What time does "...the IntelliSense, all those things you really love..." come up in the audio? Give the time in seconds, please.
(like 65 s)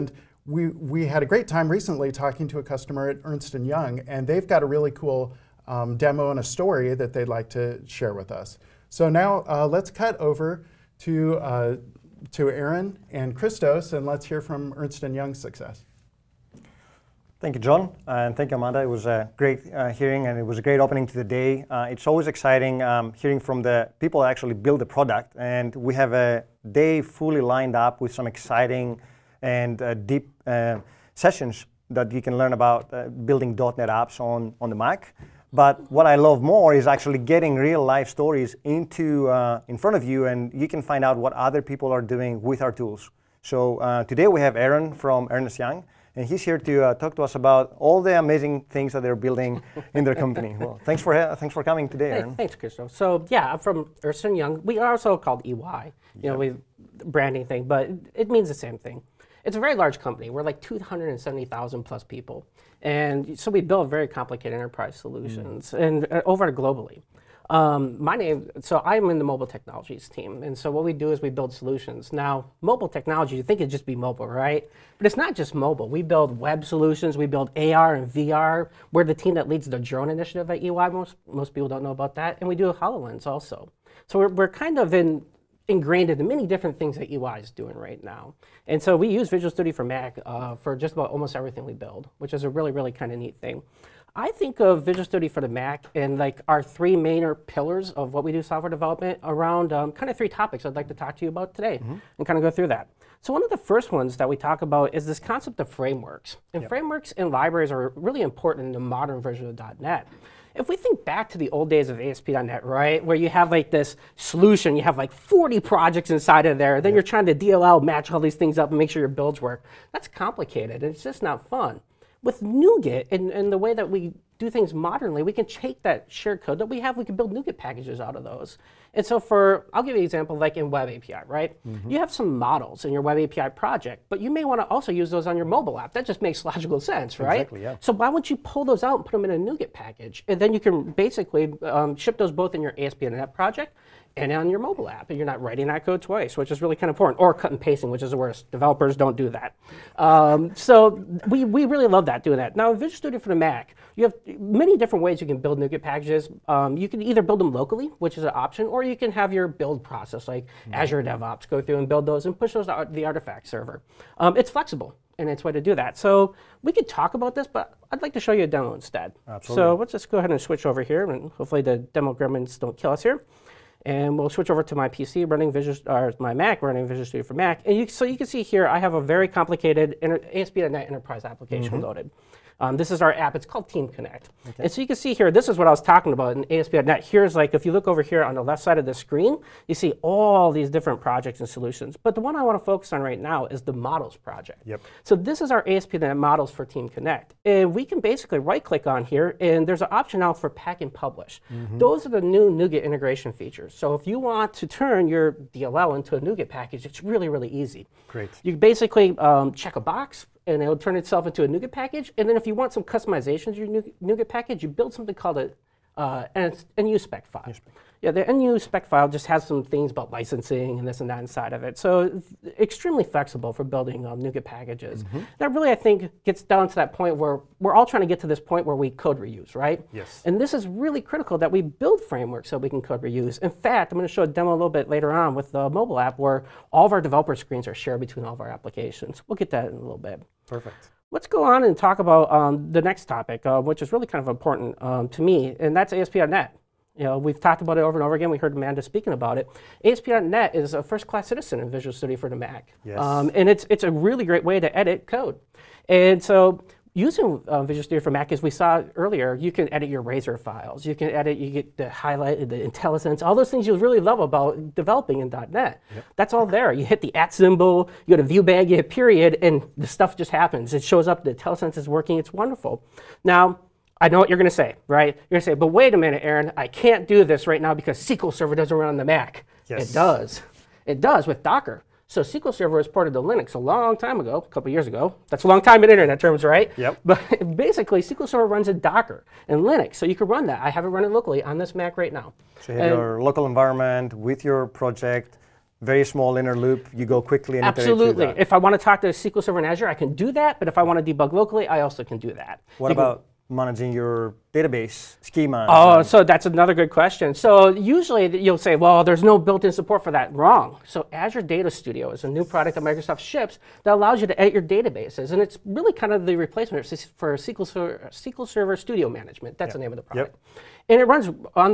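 262 s.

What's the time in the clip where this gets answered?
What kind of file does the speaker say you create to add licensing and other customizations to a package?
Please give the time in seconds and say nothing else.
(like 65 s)
218 s.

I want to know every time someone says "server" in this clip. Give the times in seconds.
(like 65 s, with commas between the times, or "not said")
163 s, 278 s, 282 s, 288 s, 299 s, 318 s.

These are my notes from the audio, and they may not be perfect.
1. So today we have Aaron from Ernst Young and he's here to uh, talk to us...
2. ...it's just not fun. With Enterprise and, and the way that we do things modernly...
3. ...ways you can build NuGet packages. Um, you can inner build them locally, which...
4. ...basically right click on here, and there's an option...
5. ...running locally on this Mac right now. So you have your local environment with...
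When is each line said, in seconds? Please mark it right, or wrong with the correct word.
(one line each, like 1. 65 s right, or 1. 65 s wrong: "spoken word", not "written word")
1. 43 s right
2. 120 s wrong: "NuGet", not "Enterprise"
3. 155 s wrong: "either", not "inner"
4. 197 s right
5. 290 s right.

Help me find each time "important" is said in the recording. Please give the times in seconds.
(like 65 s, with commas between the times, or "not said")
108 s, 146 s, 244 s.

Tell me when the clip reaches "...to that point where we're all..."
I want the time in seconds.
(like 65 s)
226 s.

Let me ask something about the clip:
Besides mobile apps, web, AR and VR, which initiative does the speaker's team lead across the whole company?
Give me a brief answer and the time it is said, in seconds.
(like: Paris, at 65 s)
The drone initiative, at 79 s.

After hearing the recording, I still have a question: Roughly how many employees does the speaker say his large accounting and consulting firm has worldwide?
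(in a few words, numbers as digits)
270,000.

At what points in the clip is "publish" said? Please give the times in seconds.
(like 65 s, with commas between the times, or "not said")
200 s.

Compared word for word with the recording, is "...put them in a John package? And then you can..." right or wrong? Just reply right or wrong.
wrong.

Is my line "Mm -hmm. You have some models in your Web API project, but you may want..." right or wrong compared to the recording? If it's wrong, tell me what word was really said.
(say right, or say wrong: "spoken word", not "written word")
right.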